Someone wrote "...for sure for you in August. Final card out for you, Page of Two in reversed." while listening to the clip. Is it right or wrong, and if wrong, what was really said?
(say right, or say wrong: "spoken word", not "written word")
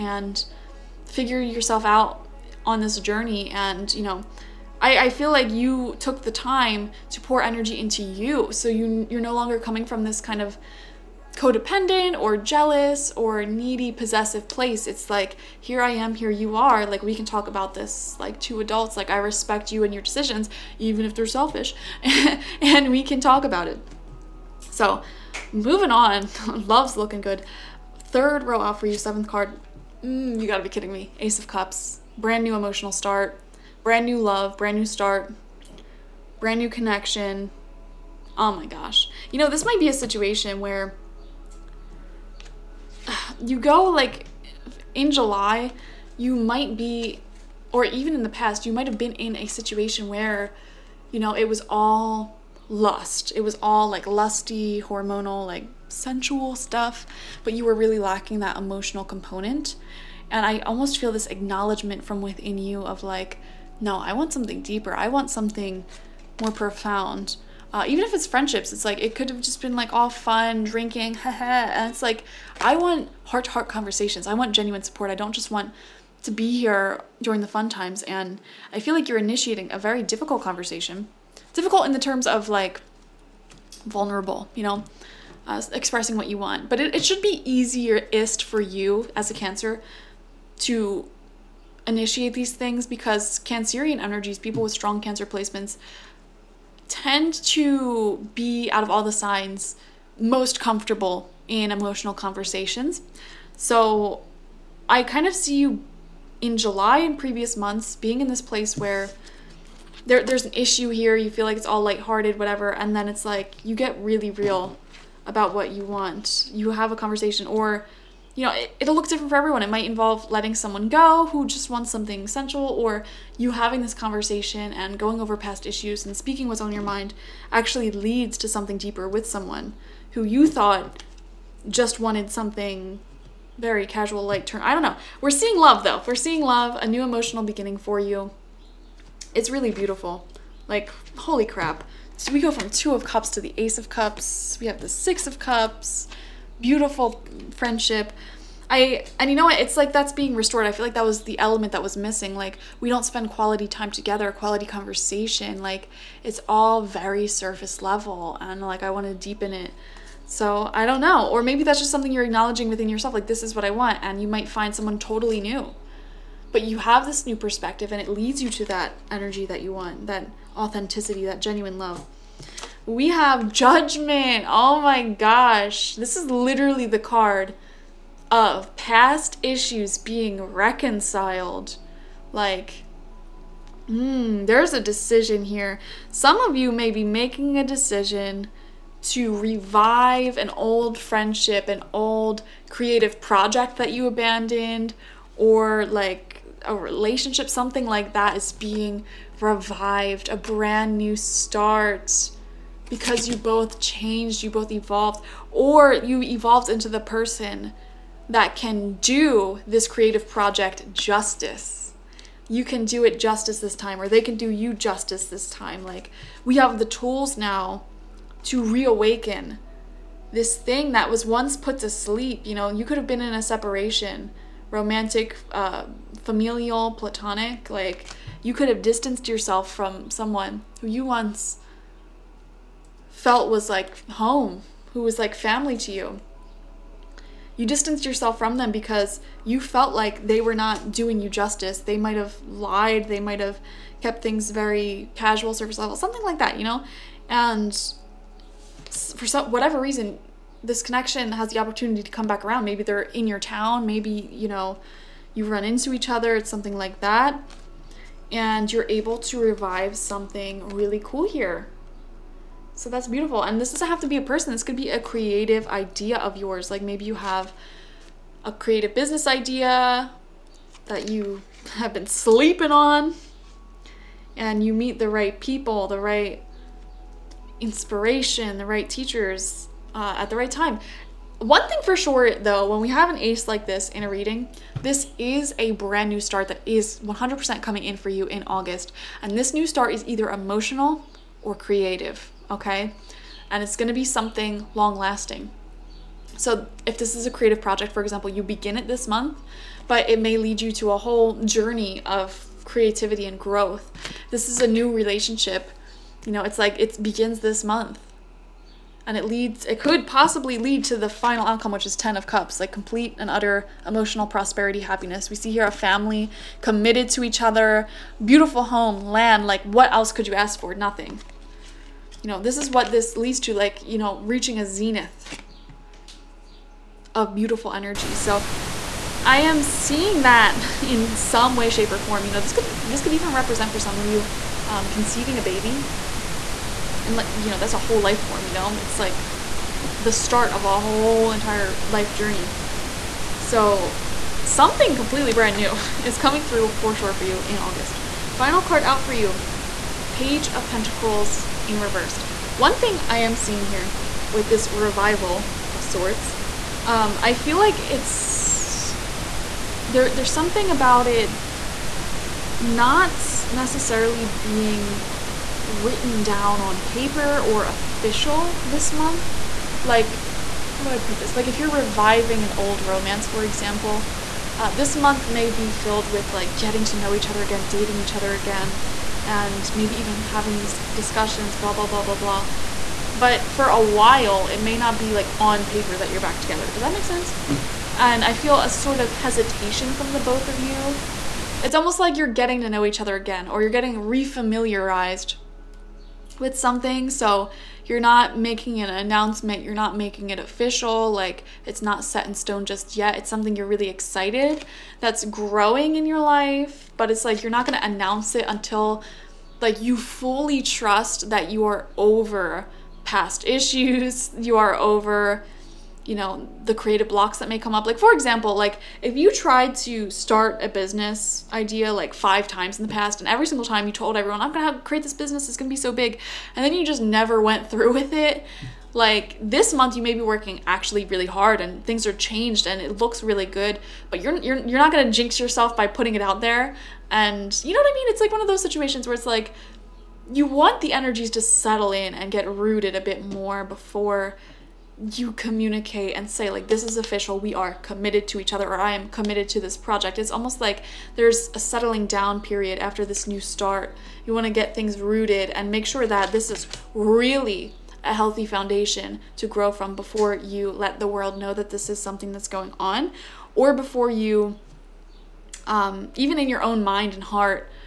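wrong: "Pentacles", not "Two".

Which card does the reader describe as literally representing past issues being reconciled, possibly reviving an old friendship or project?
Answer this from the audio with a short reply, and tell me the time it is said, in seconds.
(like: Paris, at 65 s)
Judgment, at 173 s.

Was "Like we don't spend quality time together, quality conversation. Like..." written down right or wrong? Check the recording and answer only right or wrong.
right.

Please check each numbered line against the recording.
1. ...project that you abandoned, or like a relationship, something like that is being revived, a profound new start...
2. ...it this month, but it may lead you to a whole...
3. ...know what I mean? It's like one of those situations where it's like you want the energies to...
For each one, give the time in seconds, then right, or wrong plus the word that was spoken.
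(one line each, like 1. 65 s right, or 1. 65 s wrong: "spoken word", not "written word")
1. 193 s wrong: "brand", not "profound"
2. 298 s right
3. 437 s right.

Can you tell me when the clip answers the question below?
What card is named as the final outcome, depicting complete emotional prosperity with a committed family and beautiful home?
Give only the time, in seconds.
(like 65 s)
311 s.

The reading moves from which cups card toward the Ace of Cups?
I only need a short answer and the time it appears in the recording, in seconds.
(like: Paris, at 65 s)
Two of Cups, at 142 s.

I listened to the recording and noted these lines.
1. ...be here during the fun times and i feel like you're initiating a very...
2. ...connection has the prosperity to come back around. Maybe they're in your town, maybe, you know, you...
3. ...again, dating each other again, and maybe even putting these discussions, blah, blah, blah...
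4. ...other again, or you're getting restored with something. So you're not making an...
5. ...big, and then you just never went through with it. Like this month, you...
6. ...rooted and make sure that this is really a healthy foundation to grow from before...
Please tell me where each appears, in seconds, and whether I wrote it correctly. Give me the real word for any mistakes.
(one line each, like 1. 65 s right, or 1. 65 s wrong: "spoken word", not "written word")
1. 76 s right
2. 250 s wrong: "opportunity", not "prosperity"
3. 377 s wrong: "having", not "putting"
4. 393 s wrong: "refamiliarized", not "restored"
5. 425 s right
6. 454 s right.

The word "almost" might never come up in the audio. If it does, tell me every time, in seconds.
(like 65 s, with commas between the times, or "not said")
60 s, 391 s, 450 s.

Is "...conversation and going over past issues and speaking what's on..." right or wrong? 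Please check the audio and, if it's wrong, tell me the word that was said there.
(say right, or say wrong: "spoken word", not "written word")
right.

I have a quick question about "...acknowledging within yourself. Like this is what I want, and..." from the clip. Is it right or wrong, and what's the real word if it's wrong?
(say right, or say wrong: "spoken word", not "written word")
right.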